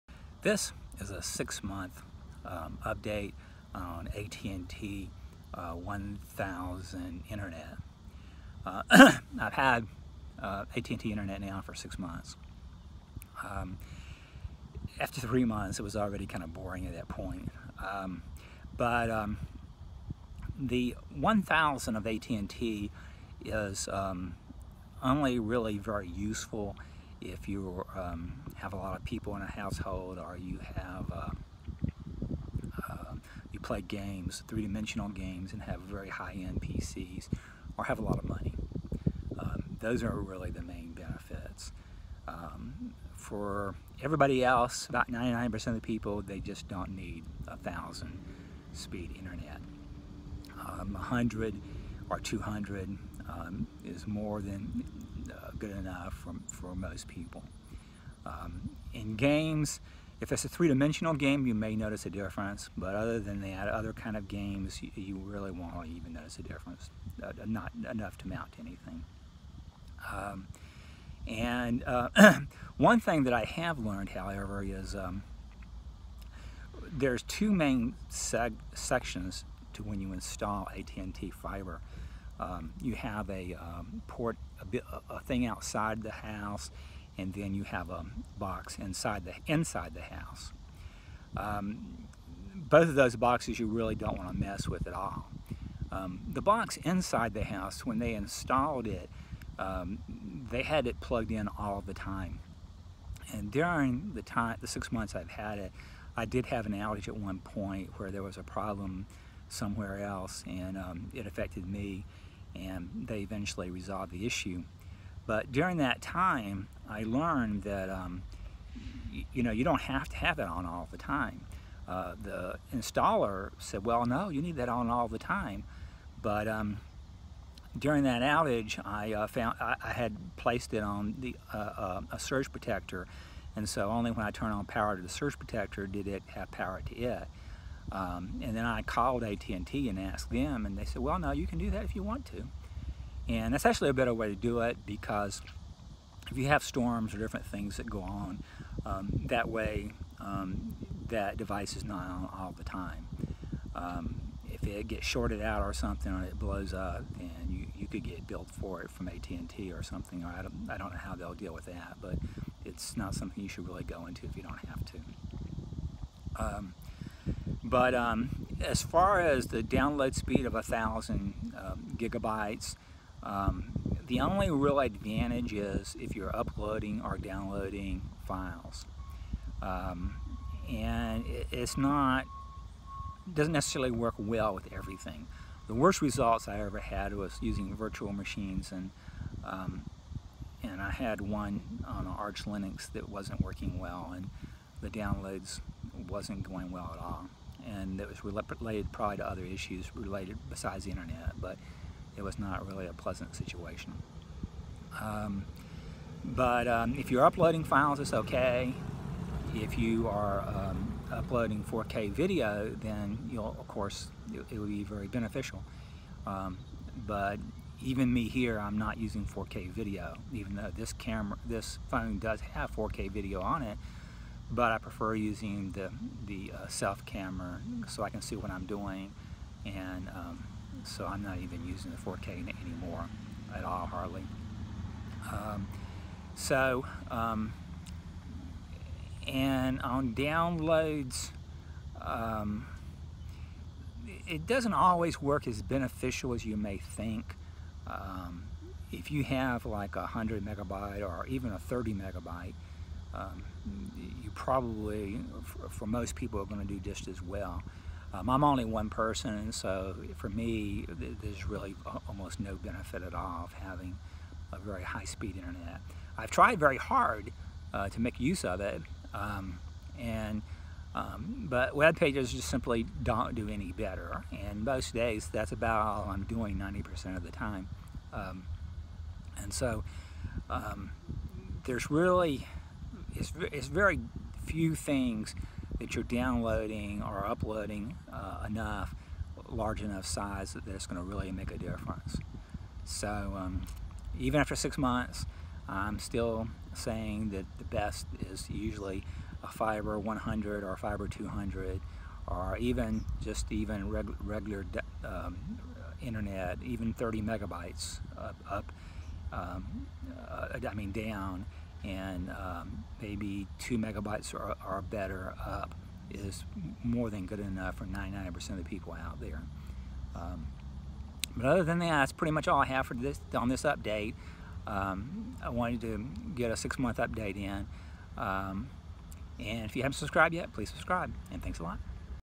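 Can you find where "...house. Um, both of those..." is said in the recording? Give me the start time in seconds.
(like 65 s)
90 s.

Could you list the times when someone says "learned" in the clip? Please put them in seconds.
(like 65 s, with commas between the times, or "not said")
73 s, 117 s.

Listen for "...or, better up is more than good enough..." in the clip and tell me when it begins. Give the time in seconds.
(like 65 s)
314 s.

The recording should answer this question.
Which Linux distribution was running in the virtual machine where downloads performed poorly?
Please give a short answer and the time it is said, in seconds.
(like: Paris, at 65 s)
Arch Linux, at 192 s.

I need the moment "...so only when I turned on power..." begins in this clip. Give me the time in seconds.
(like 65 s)
133 s.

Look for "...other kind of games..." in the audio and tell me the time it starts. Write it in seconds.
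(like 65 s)
63 s.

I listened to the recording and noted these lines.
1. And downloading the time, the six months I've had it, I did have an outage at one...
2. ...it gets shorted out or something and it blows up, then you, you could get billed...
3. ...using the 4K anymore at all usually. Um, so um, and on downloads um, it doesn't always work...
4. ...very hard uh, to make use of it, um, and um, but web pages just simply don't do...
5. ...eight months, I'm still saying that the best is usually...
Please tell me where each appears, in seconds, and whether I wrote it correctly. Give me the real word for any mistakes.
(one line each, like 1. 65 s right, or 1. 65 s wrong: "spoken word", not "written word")
1. 103 s wrong: "during", not "downloading"
2. 154 s right
3. 231 s wrong: "hardly", not "usually"
4. 266 s right
5. 294 s wrong: "six", not "eight".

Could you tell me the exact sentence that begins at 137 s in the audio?
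Um, and then I called AT&T and asked them, and they said, well, no, you can do that if you want to.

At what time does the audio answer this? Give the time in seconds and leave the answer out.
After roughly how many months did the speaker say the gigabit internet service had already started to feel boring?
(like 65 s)
15 s.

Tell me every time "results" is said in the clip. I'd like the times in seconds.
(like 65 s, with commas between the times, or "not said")
186 s.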